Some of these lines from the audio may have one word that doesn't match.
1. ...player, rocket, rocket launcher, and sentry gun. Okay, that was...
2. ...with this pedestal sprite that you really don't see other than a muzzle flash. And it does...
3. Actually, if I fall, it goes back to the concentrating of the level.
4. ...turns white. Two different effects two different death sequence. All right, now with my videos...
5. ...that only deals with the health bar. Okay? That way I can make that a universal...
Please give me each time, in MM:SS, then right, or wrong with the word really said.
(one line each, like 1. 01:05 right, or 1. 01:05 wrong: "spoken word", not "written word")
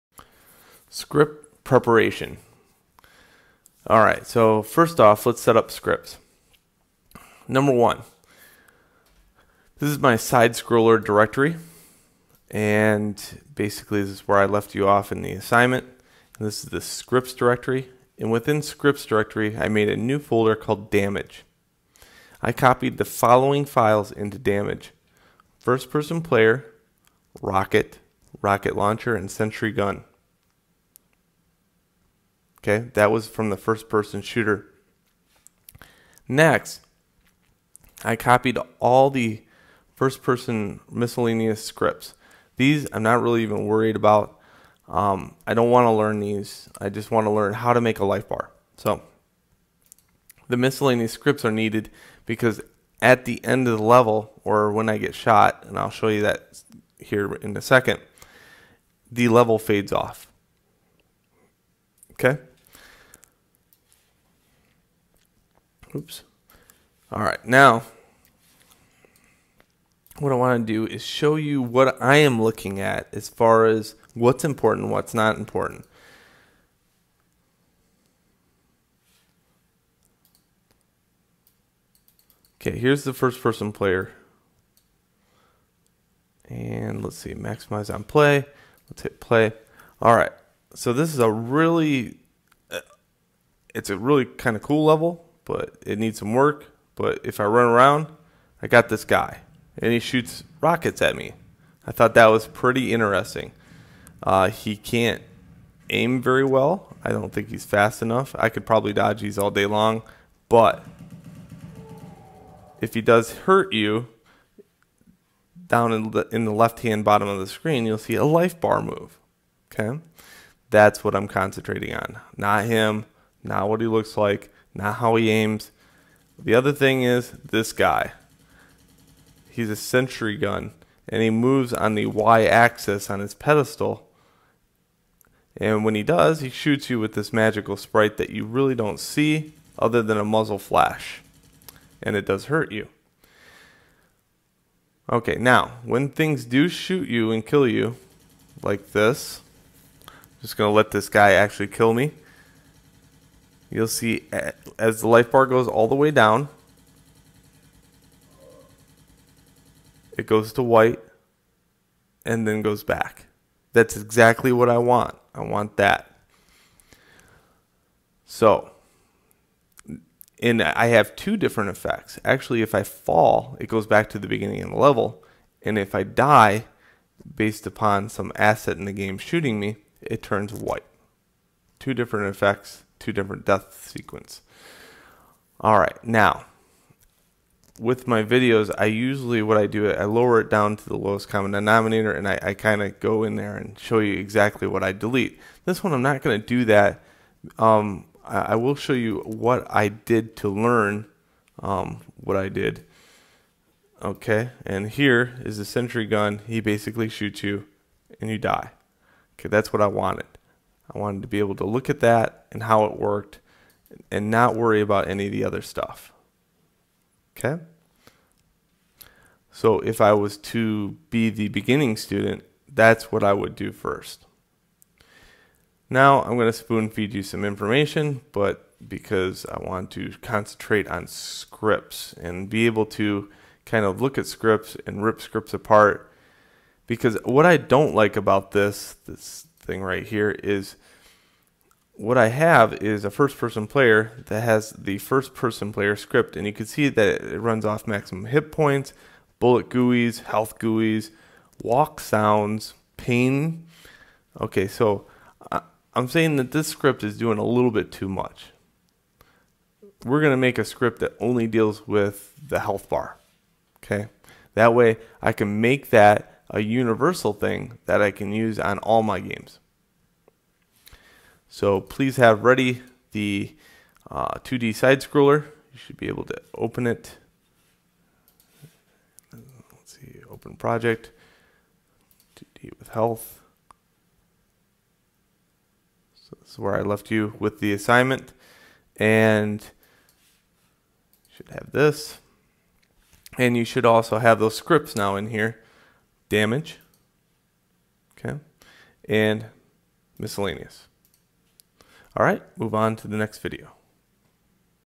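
1. 00:26 right
2. 02:16 wrong: "magical", not "pedestal"
3. 02:52 wrong: "beginning", not "concentrating"
4. 03:00 right
5. 04:20 right.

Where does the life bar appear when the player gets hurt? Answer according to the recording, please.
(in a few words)
Left-hand bottom.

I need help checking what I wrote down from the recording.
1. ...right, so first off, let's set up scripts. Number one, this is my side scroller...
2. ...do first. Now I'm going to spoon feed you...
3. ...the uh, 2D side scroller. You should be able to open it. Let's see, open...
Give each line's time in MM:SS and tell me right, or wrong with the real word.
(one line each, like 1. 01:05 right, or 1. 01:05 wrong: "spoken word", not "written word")
1. 00:04 right
2. 03:43 right
3. 04:33 right.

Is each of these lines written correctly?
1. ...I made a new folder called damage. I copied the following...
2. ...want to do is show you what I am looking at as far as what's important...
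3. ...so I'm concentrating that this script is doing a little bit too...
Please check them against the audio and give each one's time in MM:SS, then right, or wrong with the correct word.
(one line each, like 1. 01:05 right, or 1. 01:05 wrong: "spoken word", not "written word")
1. 00:19 right
2. 01:10 right
3. 04:14 wrong: "saying", not "concentrating".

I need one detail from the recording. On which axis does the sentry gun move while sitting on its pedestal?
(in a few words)
y-axis.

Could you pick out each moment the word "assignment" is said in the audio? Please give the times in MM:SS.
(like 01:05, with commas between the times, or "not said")
00:15, 04:47.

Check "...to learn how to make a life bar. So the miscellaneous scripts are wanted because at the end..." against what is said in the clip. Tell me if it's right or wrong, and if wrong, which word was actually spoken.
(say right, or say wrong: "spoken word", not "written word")
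wrong: "needed", not "wanted".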